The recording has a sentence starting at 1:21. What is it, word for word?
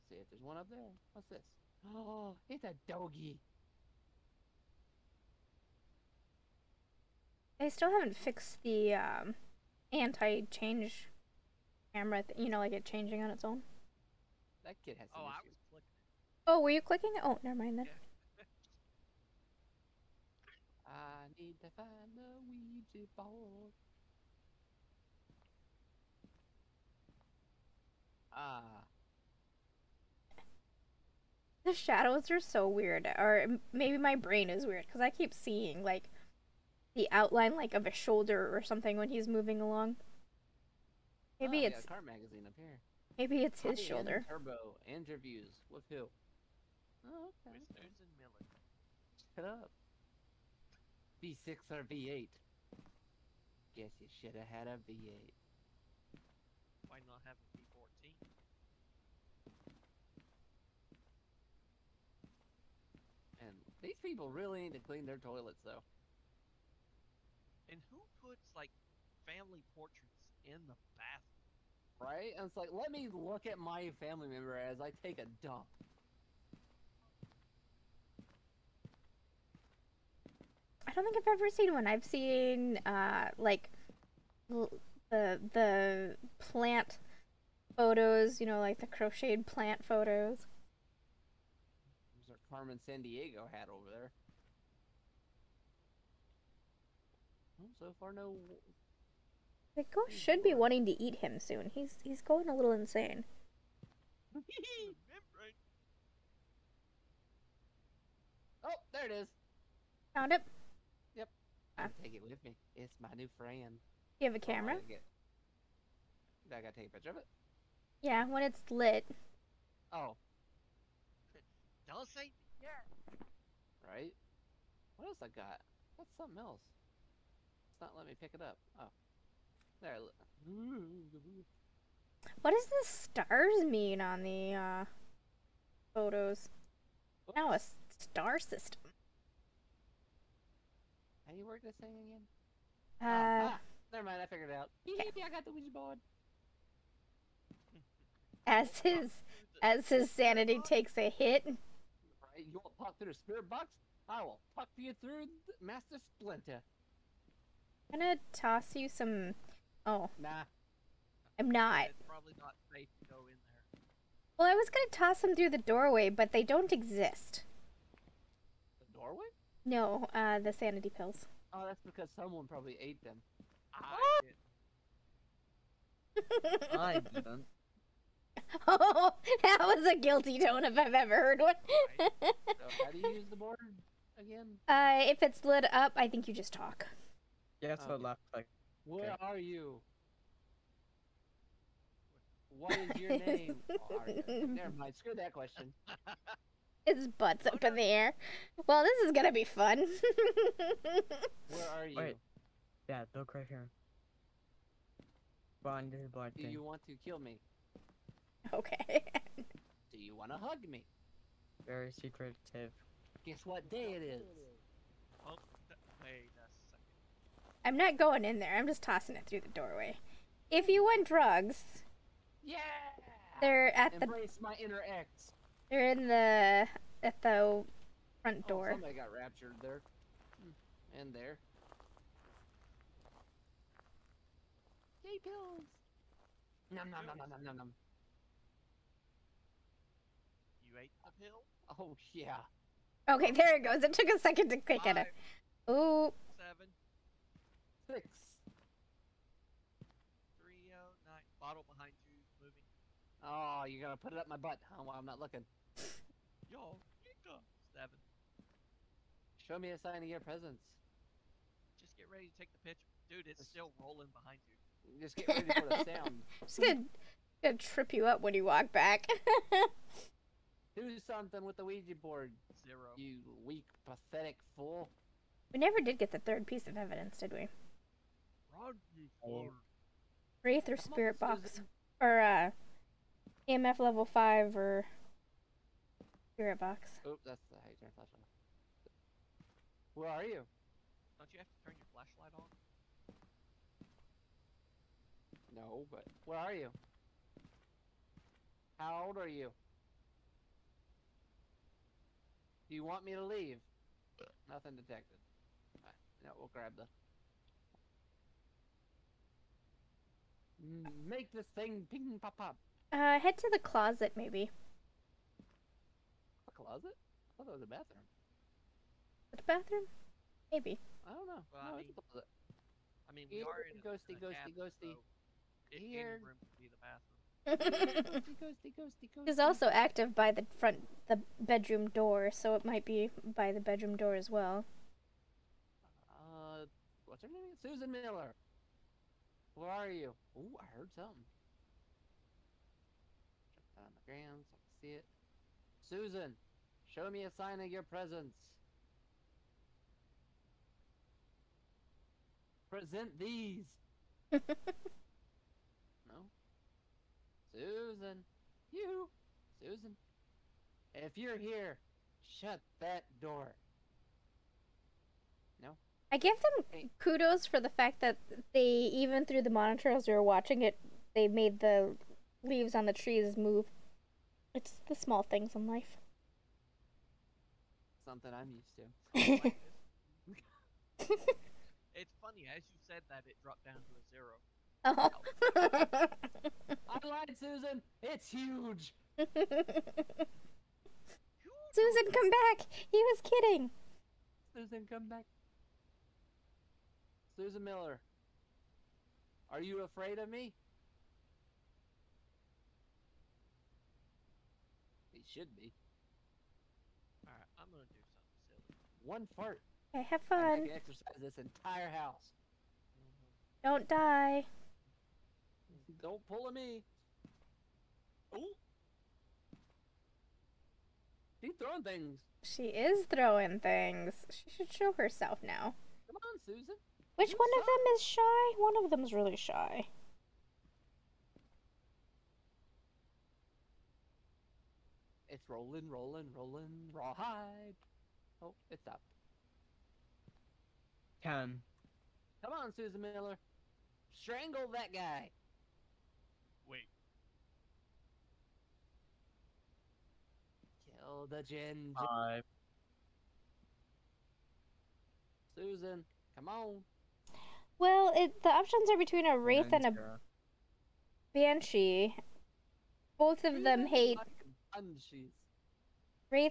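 I've seen uh, like the the plant photos, you know, like the crocheted plant photos.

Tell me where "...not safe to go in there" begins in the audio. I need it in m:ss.
2:42.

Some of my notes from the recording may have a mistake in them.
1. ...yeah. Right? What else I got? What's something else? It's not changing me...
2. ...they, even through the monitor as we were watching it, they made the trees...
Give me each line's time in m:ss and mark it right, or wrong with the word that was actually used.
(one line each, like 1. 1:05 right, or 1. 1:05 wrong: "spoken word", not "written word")
1. 2:02 wrong: "letting", not "changing"
2. 6:08 wrong: "leaves", not "trees".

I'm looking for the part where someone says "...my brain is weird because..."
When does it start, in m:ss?
0:33.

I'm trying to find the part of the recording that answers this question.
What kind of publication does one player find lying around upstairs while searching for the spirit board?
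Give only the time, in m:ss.
0:41.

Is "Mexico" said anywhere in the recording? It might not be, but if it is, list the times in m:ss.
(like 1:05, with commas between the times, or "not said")
not said.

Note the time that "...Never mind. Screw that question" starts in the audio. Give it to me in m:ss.
3:14.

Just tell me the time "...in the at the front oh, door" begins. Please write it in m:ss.
3:45.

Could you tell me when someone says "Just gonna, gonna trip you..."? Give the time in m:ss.
4:26.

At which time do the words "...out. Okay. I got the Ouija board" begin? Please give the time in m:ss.
2:24.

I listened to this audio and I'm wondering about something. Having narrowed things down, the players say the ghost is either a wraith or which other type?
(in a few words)
Banshee.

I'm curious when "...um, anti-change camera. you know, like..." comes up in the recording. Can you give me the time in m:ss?
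0:08.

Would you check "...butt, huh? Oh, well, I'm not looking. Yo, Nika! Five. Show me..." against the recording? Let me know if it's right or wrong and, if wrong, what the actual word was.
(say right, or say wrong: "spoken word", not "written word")
wrong: "Seven", not "Five".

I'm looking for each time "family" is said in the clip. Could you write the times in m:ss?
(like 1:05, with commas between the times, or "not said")
1:09, 1:14.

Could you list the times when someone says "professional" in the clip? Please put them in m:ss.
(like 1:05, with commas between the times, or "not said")
not said.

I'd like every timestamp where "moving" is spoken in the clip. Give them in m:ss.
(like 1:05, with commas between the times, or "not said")
0:39, 4:12.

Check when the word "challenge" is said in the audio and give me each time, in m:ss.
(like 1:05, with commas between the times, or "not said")
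not said.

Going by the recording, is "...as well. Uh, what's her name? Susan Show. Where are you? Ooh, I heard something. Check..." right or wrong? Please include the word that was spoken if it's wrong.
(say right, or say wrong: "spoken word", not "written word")
wrong: "Miller", not "Show".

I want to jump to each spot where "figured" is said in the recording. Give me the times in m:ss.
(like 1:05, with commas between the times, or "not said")
2:24.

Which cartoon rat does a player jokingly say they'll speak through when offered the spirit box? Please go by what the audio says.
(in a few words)
Master Splinter.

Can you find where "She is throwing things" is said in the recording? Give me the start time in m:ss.
7:02.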